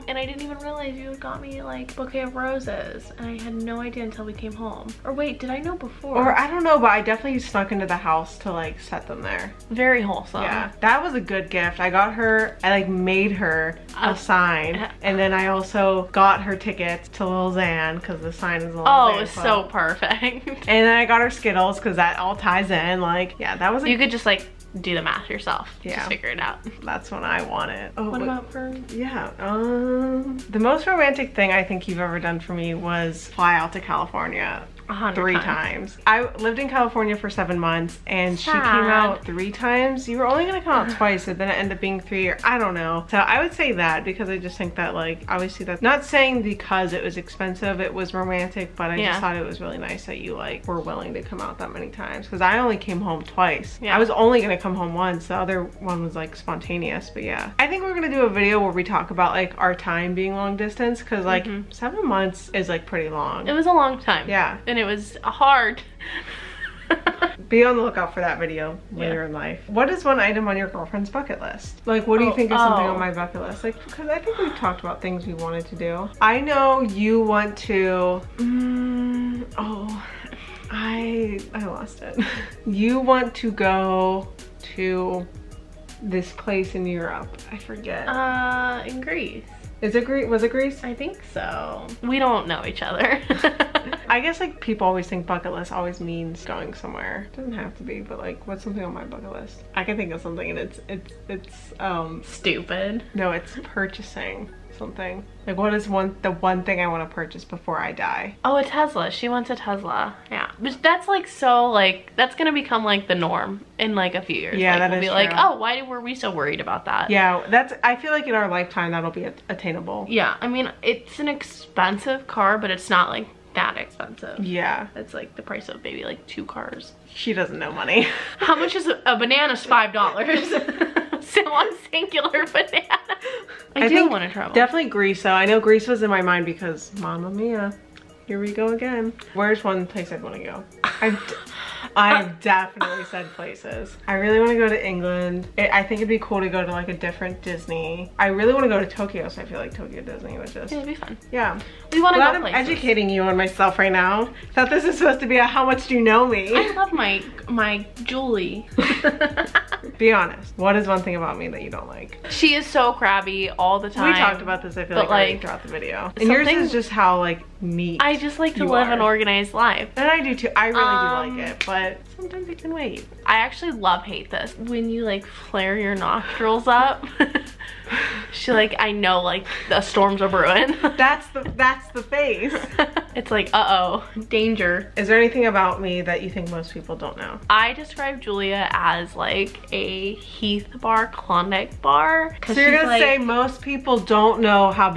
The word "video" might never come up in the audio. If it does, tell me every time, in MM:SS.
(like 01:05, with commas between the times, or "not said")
00:58, 01:08, 02:45.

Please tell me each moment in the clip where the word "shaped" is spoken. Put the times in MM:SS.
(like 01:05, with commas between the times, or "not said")
not said.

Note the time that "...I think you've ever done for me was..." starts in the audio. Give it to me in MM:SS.
00:31.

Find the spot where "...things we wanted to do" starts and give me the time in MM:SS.
01:15.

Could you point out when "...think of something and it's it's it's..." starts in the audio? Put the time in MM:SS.
01:39.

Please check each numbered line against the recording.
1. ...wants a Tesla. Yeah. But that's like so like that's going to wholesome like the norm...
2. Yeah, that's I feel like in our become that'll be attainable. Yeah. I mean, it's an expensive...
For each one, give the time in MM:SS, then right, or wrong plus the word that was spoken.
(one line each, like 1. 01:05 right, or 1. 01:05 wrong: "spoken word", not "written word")
1. 01:49 wrong: "become", not "wholesome"
2. 01:57 wrong: "lifetime", not "become".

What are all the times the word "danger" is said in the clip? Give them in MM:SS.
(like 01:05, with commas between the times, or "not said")
03:04.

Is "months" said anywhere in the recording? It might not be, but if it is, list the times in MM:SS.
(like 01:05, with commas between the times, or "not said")
00:37, 01:02.